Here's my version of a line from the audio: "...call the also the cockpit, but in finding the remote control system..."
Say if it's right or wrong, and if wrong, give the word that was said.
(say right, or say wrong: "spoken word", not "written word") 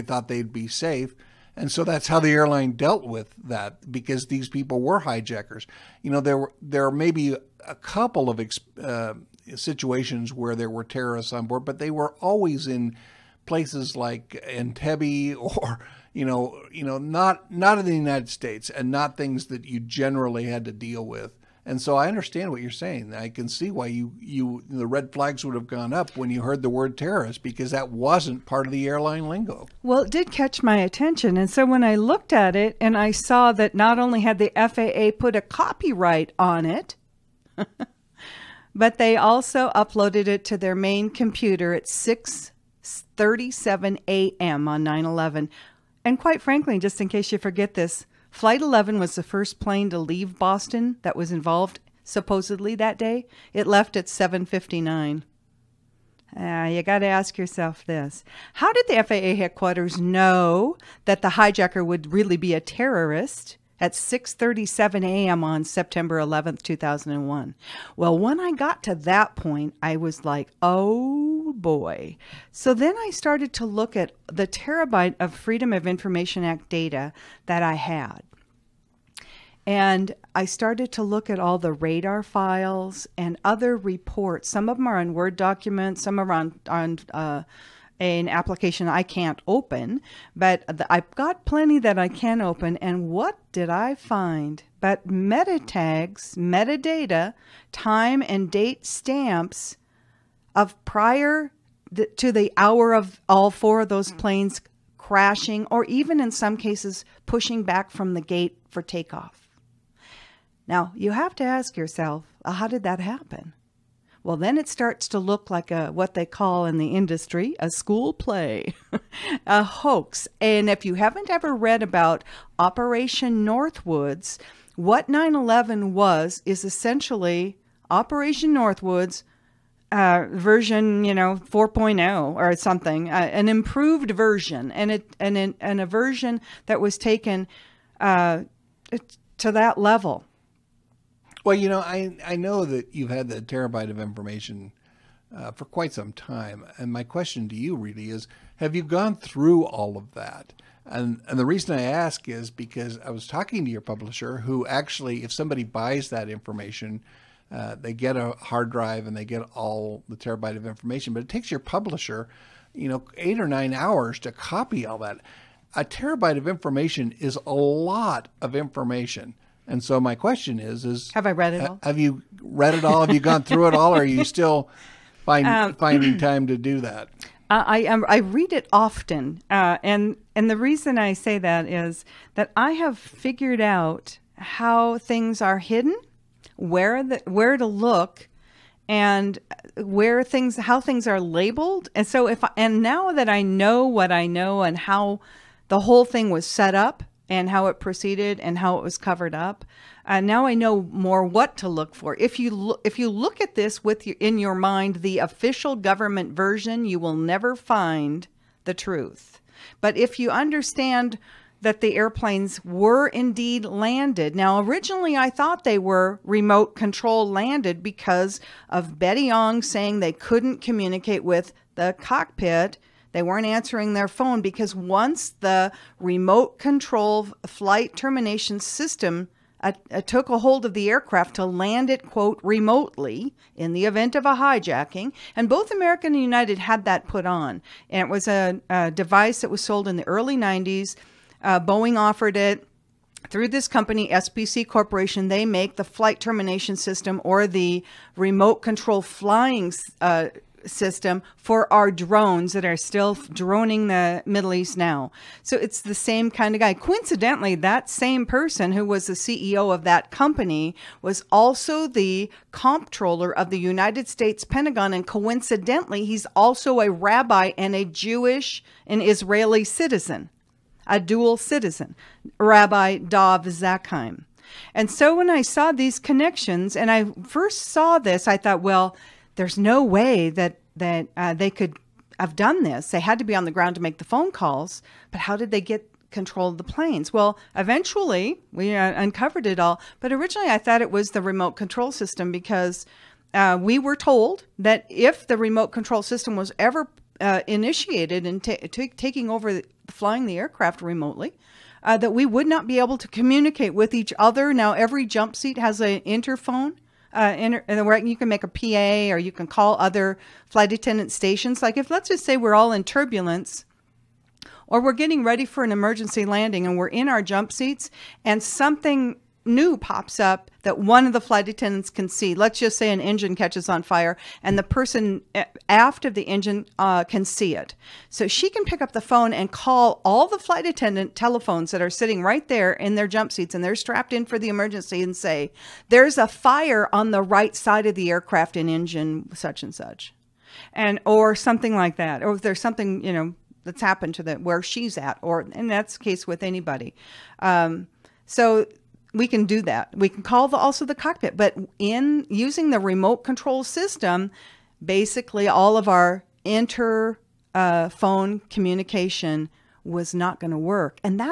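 wrong: "using", not "finding".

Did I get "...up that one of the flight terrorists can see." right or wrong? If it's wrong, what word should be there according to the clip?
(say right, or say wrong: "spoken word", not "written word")
wrong: "attendants", not "terrorists".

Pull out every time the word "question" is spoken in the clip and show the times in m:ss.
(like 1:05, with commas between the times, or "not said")
2:27, 2:50.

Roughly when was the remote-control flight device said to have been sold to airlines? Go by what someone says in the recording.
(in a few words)
early 90s.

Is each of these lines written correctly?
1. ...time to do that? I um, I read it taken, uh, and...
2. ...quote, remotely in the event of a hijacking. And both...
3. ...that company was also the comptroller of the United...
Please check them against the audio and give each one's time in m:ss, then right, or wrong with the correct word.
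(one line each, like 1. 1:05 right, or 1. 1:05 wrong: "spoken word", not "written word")
1. 2:56 wrong: "often", not "taken"
2. 3:52 right
3. 4:19 right.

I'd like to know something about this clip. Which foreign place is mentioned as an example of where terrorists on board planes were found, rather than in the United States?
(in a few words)
Entebbe.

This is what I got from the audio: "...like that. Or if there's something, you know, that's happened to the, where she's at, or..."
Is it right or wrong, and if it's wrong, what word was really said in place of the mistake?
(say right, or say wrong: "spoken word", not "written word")
right.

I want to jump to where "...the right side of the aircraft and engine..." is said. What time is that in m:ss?
5:37.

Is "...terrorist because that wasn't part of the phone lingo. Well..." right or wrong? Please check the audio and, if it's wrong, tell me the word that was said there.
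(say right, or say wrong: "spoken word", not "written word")
wrong: "airline", not "phone".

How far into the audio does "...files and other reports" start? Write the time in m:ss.
1:22.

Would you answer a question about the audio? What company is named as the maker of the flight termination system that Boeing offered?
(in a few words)
SPC Corporation.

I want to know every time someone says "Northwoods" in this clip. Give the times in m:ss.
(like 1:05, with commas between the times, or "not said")
2:03, 2:08.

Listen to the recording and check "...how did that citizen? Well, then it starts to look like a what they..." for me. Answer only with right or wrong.
wrong.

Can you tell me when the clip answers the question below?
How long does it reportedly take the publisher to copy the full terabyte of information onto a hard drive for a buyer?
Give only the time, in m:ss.
2:43.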